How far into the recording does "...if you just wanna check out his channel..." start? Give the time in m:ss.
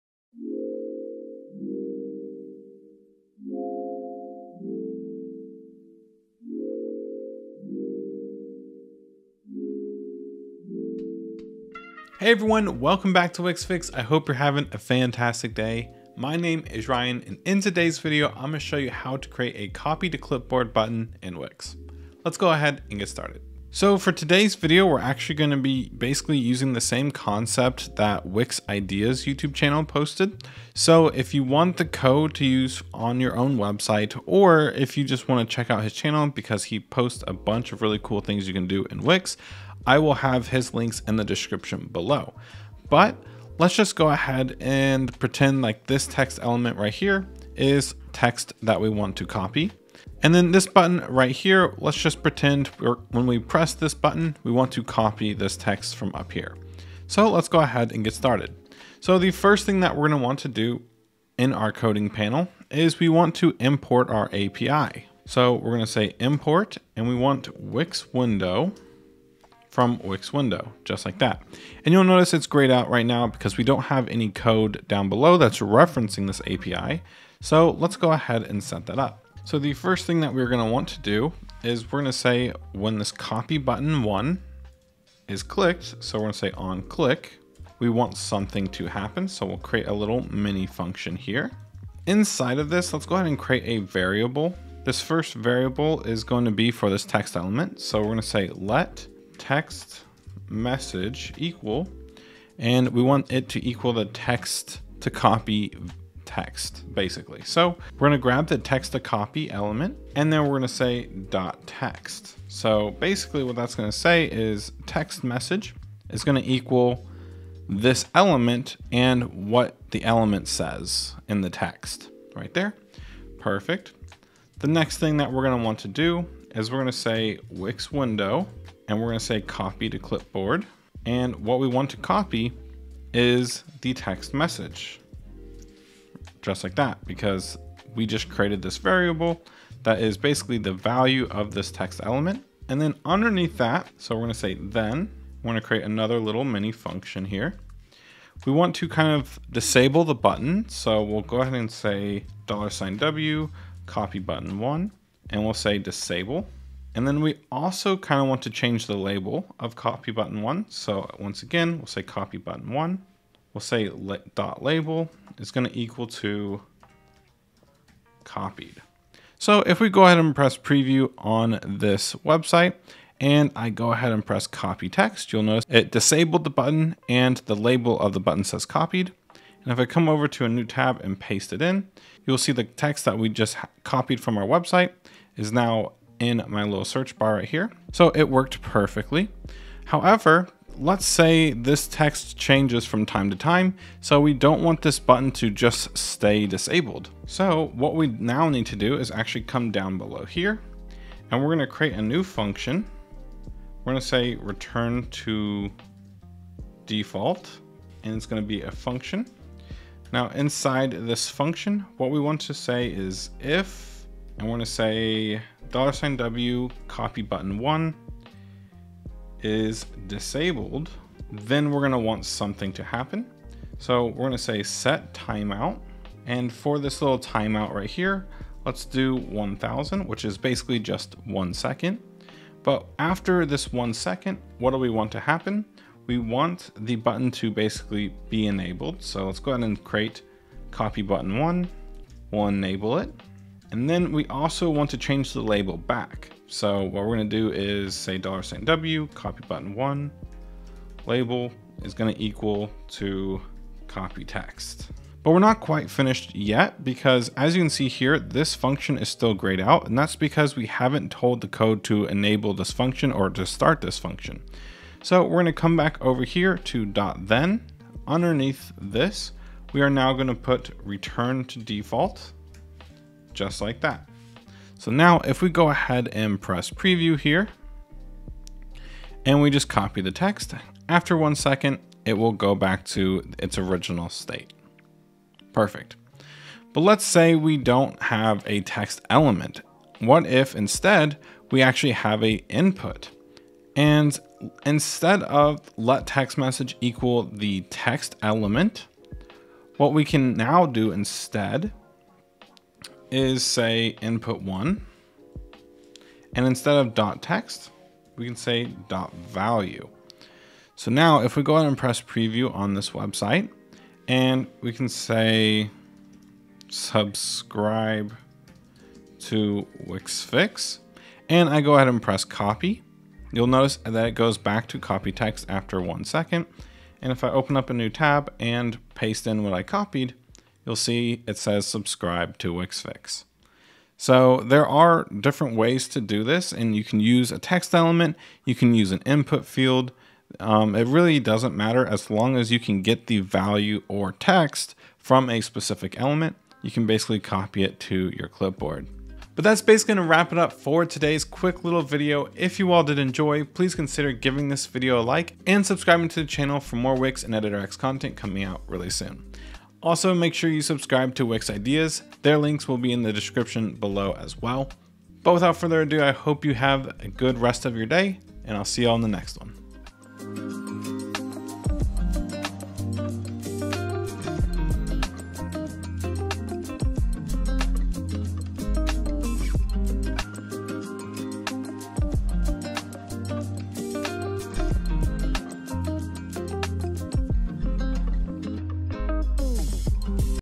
0:34.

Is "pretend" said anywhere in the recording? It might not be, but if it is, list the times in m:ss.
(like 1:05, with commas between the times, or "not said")
0:45, 0:52.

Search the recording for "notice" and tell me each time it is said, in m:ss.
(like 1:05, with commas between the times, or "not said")
1:12, 2:55, 5:23.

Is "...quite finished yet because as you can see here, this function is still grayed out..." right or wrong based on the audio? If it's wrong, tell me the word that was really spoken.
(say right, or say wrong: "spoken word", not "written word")
right.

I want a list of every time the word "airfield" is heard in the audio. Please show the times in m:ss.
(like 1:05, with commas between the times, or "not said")
not said.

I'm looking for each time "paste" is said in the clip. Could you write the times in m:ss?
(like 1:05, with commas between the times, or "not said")
3:01, 5:28.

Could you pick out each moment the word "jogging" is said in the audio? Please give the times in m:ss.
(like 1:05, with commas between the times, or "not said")
not said.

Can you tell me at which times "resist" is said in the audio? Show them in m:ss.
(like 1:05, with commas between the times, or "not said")
not said.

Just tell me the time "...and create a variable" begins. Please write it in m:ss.
1:33.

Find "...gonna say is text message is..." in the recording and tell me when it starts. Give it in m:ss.
1:53.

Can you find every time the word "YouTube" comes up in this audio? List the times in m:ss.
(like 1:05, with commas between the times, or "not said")
0:29.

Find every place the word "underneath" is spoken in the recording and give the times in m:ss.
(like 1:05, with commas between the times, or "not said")
2:23, 4:28.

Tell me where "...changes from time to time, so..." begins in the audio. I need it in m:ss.
3:12.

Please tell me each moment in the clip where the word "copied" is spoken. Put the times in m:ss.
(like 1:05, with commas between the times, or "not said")
2:48, 2:58, 3:03, 5:29.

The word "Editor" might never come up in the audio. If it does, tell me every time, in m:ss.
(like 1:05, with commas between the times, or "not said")
5:57.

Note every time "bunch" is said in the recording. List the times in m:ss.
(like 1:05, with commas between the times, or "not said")
0:37.